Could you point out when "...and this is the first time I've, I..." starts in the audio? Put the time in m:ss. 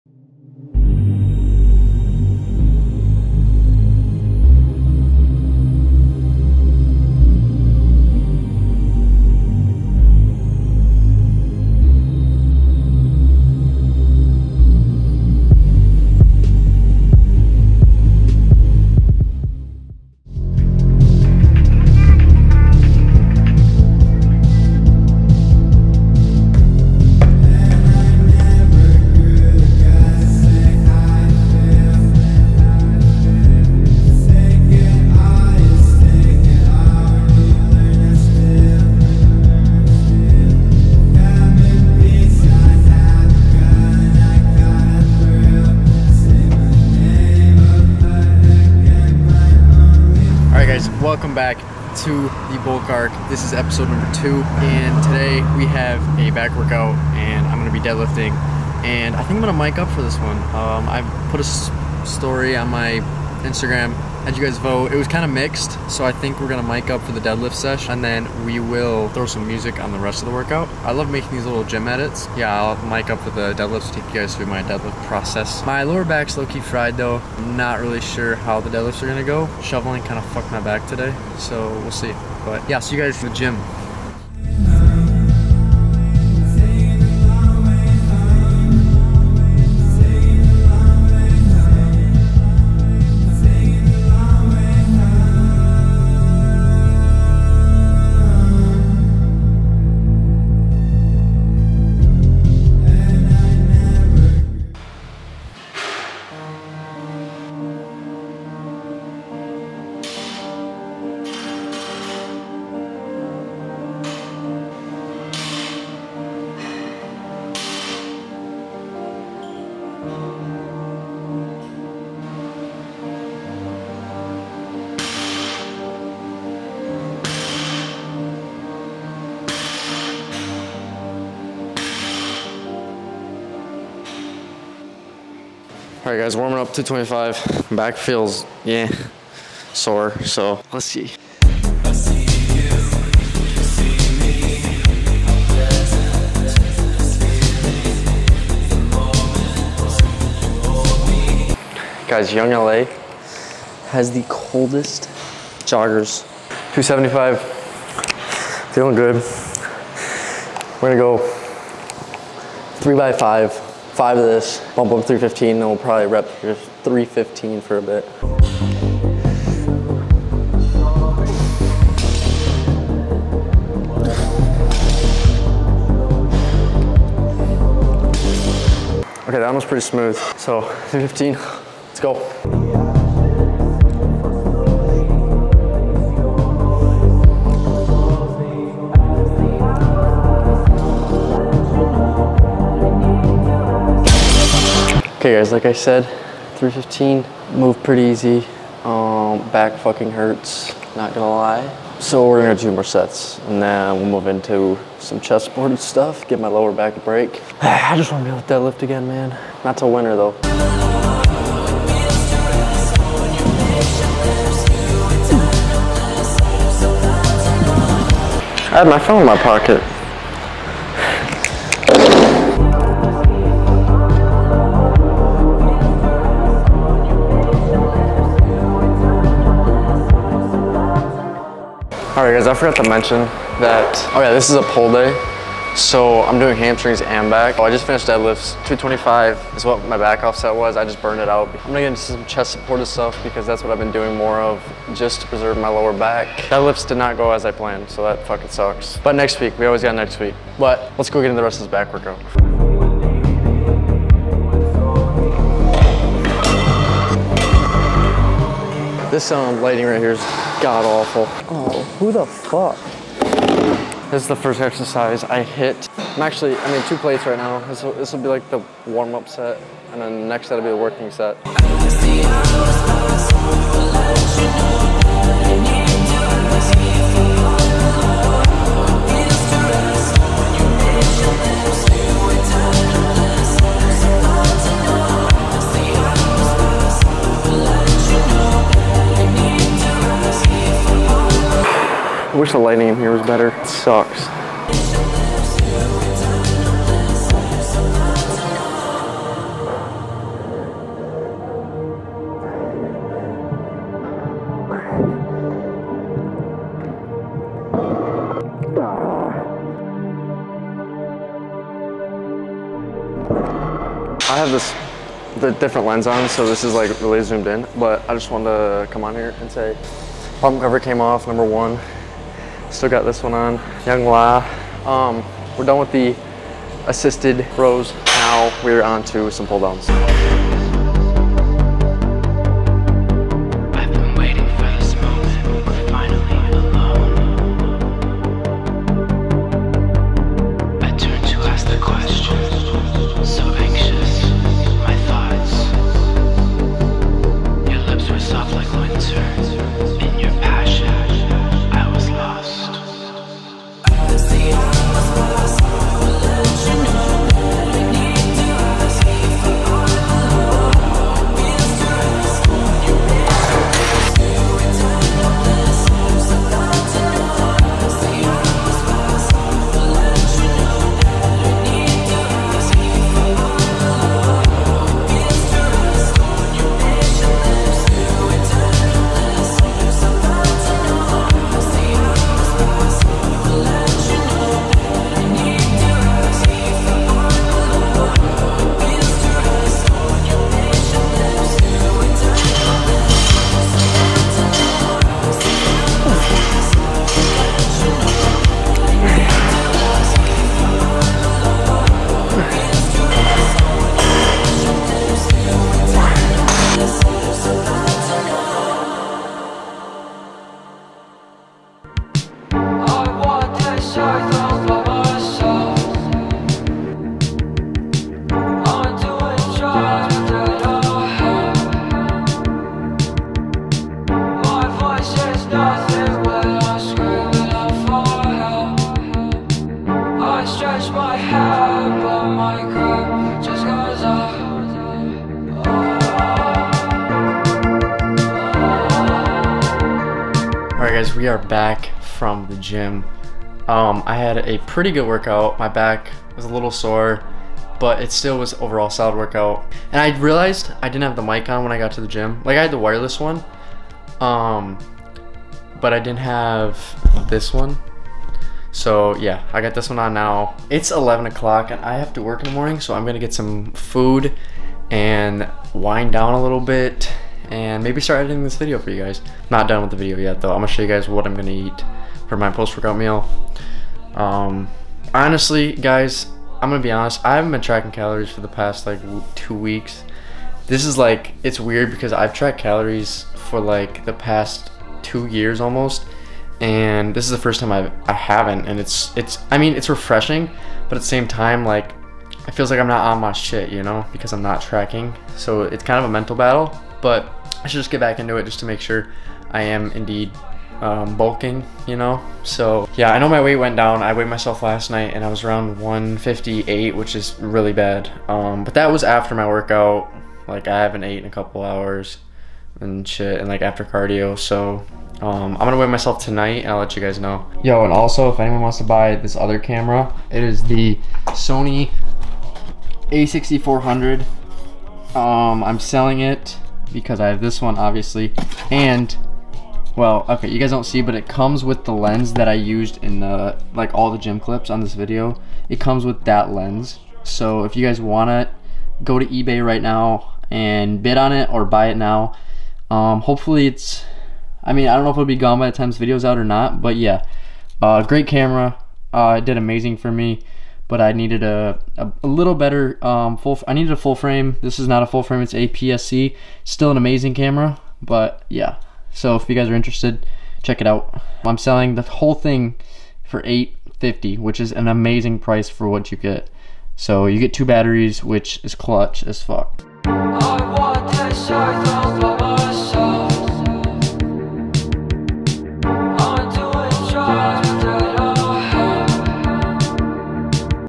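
8:06.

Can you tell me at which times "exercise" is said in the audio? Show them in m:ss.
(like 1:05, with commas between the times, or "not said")
4:24.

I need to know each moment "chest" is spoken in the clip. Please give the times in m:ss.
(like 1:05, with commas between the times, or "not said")
3:25, 4:02.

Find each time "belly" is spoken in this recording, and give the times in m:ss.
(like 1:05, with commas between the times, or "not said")
not said.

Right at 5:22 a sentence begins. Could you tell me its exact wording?
Still got this one on, Young LA.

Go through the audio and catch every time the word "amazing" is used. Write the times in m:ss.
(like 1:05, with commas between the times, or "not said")
9:09, 9:16, 9:24.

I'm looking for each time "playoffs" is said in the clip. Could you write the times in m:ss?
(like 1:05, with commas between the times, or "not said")
not said.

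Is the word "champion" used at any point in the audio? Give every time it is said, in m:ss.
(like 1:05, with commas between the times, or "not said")
not said.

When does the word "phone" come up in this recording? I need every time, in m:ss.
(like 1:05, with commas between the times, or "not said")
3:38.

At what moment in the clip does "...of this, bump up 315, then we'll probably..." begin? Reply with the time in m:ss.
2:44.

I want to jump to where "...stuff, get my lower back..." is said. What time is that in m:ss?
3:25.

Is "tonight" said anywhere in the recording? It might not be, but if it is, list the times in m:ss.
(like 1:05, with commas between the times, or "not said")
8:36.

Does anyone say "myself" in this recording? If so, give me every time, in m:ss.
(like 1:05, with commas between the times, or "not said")
8:24, 8:35.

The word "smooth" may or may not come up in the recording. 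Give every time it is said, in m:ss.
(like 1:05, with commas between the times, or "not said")
2:59.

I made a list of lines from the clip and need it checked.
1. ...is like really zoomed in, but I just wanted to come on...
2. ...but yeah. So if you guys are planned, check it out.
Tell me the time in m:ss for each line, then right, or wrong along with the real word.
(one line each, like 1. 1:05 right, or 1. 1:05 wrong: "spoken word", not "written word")
1. 5:16 right
2. 9:18 wrong: "interested", not "planned".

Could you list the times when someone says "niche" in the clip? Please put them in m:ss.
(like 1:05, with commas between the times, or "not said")
not said.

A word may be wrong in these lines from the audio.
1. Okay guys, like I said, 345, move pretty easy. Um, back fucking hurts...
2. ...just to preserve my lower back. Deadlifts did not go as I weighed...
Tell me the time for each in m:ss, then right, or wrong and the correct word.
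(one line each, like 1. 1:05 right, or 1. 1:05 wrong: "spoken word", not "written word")
1. 3:15 wrong: "315", not "345"
2. 4:04 wrong: "planned", not "weighed".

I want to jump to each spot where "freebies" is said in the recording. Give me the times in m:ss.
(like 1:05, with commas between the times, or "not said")
not said.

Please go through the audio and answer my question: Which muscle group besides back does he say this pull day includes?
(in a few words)
hamstrings.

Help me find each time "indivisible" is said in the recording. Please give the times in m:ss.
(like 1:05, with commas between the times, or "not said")
not said.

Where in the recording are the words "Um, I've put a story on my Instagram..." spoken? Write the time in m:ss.
1:00.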